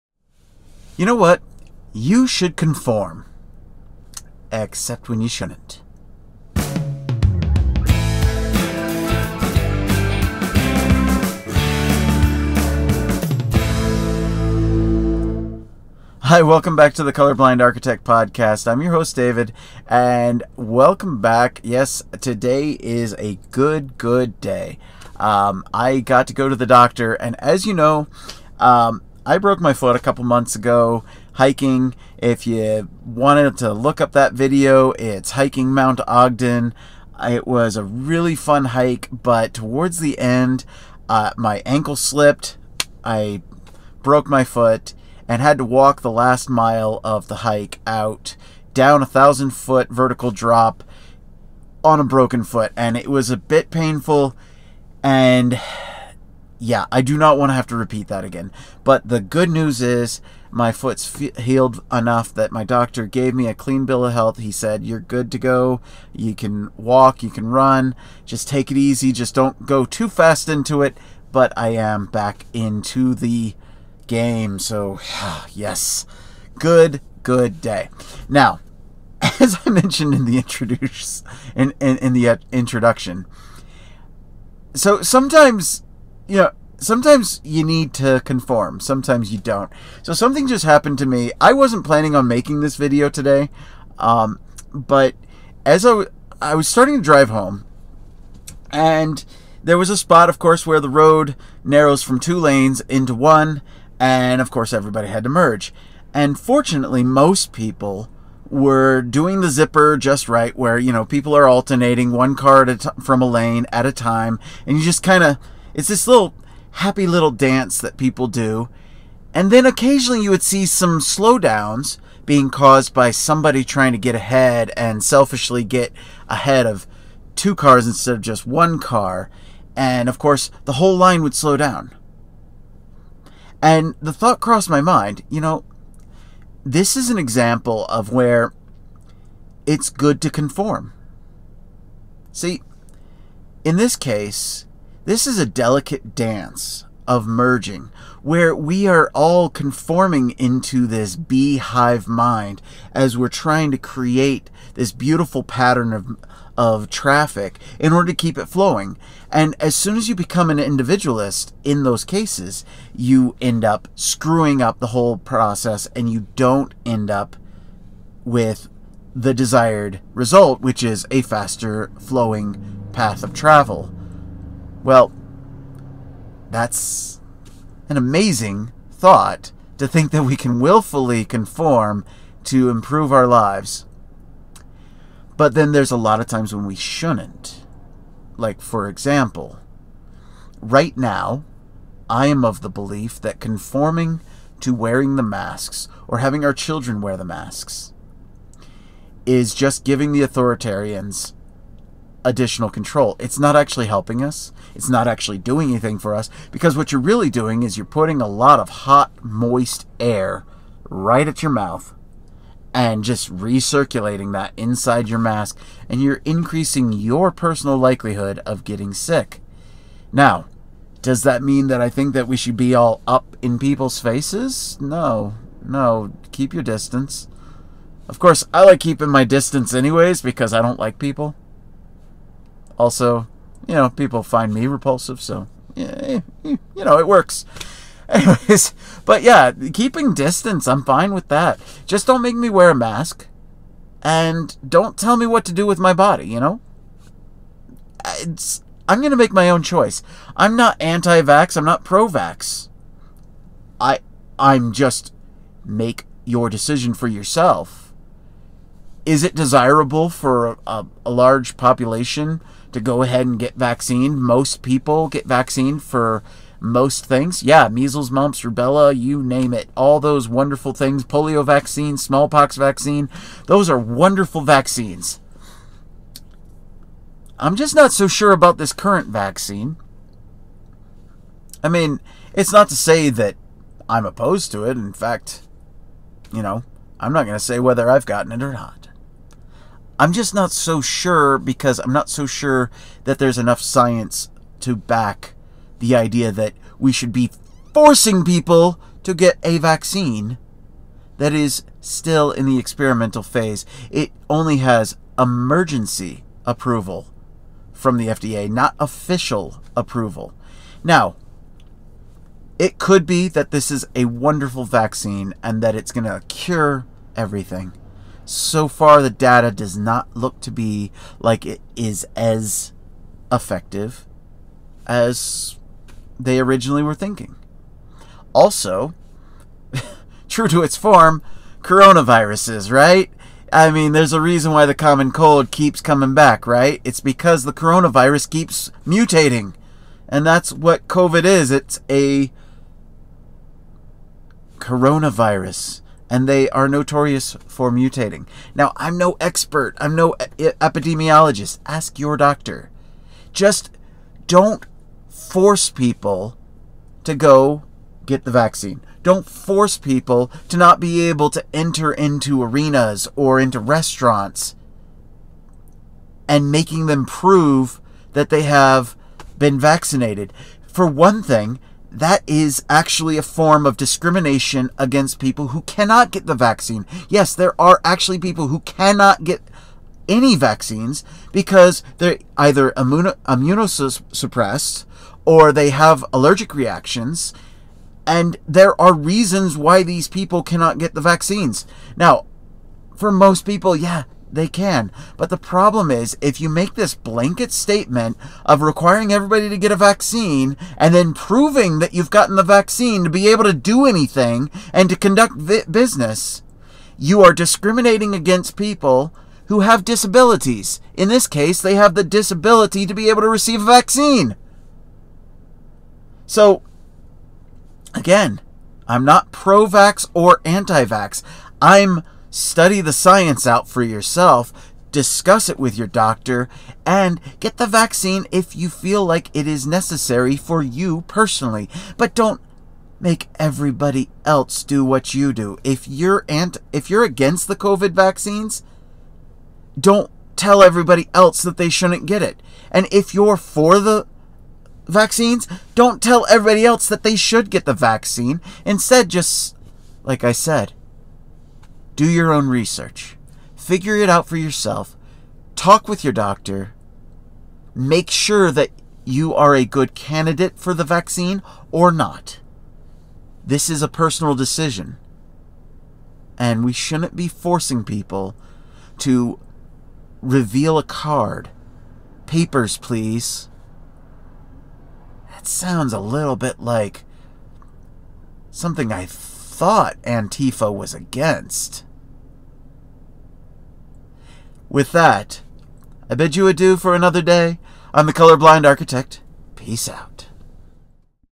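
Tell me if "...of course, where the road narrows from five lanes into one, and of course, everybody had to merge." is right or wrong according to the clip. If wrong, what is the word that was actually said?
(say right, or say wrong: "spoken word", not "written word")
wrong: "two", not "five".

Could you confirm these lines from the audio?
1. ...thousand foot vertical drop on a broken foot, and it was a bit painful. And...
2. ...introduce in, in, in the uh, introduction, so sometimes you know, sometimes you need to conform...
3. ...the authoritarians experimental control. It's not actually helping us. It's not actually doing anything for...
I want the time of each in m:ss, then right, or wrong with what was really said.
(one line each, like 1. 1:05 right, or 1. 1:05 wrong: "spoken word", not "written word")
1. 0:49 right
2. 1:20 right
3. 3:20 wrong: "additional", not "experimental".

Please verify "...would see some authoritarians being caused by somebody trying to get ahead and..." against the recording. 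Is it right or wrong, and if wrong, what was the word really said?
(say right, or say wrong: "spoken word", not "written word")
wrong: "slowdowns", not "authoritarians".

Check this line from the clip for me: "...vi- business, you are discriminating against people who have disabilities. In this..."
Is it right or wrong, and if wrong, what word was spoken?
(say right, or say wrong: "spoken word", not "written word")
right.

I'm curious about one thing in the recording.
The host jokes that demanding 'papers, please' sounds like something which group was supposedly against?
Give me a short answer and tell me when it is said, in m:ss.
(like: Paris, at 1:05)
Antifa, at 8:00.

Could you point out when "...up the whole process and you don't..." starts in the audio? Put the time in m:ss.
2:44.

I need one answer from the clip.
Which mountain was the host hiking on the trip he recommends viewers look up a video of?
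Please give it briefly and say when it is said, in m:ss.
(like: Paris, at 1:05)
Mount Ogden, at 0:35.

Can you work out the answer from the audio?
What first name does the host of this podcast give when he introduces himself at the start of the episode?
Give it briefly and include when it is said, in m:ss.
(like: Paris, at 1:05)
David, at 0:19.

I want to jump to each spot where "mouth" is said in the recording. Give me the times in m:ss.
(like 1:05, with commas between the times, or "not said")
3:31.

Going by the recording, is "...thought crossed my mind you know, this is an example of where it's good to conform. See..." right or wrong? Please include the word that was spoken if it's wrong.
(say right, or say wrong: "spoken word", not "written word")
right.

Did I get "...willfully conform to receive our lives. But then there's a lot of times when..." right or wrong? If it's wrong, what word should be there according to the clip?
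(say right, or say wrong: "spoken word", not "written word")
wrong: "improve", not "receive".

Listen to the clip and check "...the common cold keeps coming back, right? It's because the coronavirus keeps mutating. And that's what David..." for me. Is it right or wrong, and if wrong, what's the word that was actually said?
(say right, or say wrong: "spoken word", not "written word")
wrong: "COVID", not "David".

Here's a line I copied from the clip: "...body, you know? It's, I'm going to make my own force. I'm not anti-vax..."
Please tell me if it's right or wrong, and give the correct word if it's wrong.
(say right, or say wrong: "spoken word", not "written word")
wrong: "choice", not "force".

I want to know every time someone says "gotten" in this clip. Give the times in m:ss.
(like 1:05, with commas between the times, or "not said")
4:48, 6:42.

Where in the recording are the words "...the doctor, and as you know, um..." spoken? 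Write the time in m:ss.
0:26.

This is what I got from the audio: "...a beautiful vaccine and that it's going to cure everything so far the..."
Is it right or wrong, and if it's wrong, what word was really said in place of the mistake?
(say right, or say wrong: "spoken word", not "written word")
wrong: "wonderful", not "beautiful".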